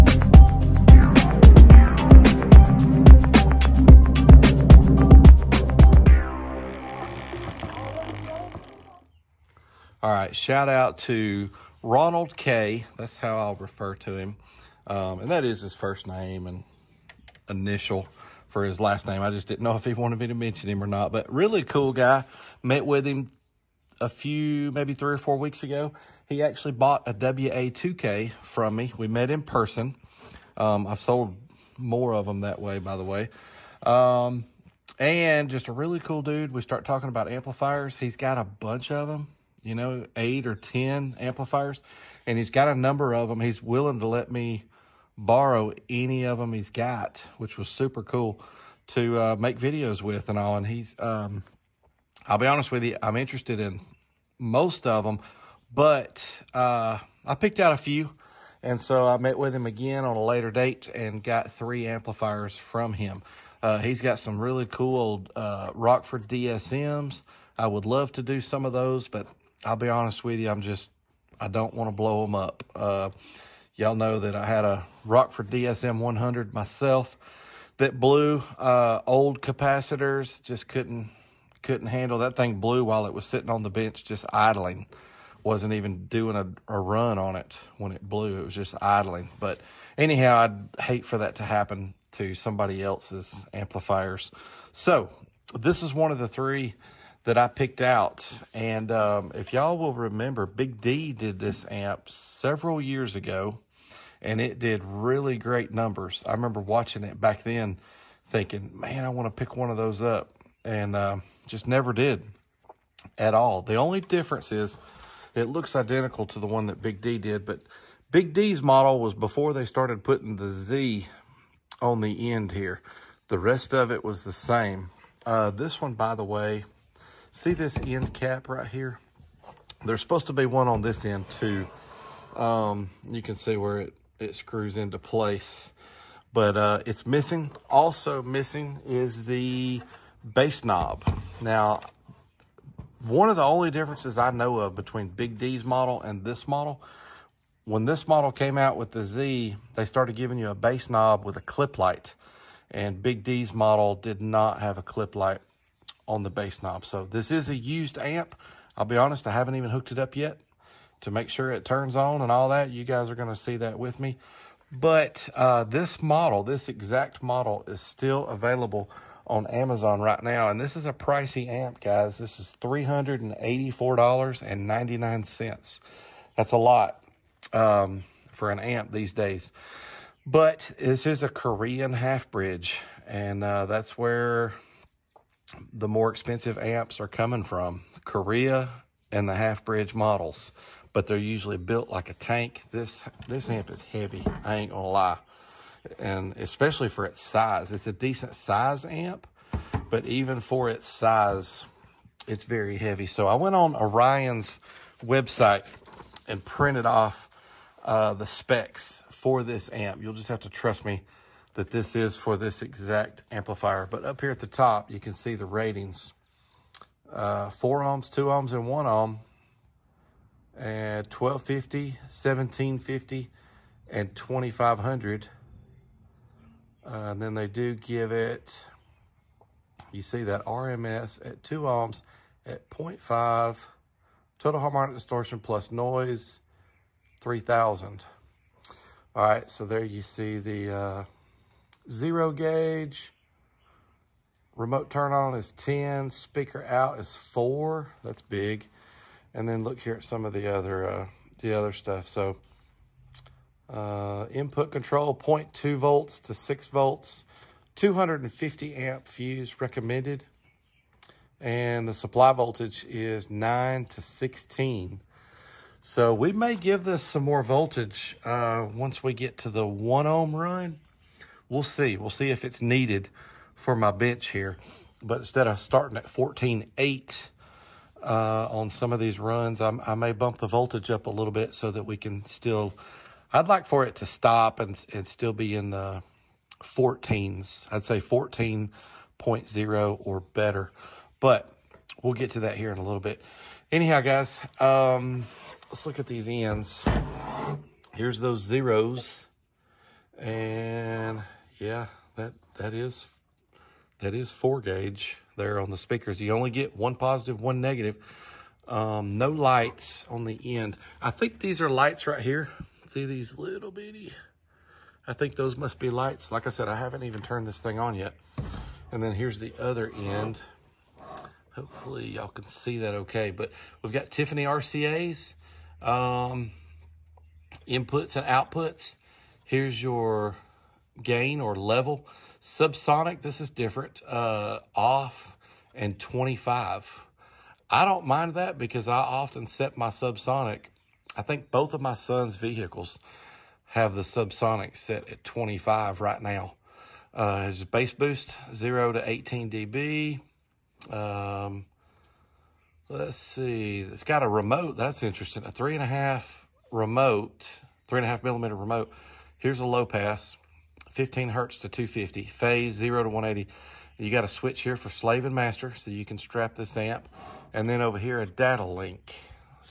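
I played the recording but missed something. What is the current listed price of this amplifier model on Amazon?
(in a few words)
$384.99.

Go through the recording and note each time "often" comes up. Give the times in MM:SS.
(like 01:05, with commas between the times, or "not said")
05:38.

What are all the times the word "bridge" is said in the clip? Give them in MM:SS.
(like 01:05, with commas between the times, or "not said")
03:02, 03:09.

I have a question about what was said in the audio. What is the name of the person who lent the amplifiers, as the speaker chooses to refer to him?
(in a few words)
Ronald K.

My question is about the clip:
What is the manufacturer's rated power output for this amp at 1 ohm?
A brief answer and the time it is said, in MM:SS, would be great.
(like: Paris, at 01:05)
2500, at 03:44.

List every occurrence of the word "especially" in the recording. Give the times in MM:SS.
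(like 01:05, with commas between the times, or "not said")
03:16.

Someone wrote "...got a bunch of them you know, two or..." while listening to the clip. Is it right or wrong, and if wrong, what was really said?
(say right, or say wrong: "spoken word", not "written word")
wrong: "eight", not "two".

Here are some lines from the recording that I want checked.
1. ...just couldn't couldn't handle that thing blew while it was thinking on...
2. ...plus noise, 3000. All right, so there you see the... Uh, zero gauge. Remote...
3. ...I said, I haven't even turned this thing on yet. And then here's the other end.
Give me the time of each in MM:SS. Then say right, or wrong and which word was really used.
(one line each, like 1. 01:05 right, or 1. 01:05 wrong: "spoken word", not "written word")
1. 01:20 wrong: "sitting", not "thinking"
2. 03:55 right
3. 05:16 right.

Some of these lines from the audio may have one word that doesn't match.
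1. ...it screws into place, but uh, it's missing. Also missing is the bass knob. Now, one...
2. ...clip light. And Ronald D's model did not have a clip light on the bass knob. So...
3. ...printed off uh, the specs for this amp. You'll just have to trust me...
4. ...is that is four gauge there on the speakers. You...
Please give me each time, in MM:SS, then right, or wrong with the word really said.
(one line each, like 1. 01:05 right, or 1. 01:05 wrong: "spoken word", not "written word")
1. 02:14 right
2. 02:31 wrong: "Big", not "Ronald"
3. 03:26 right
4. 05:02 right.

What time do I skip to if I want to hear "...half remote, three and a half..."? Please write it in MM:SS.
05:55.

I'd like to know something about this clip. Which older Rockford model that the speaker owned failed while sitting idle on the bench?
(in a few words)
DSM 100.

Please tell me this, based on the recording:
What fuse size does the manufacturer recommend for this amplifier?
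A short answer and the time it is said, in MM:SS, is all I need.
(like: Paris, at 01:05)
250 amp, at 04:17.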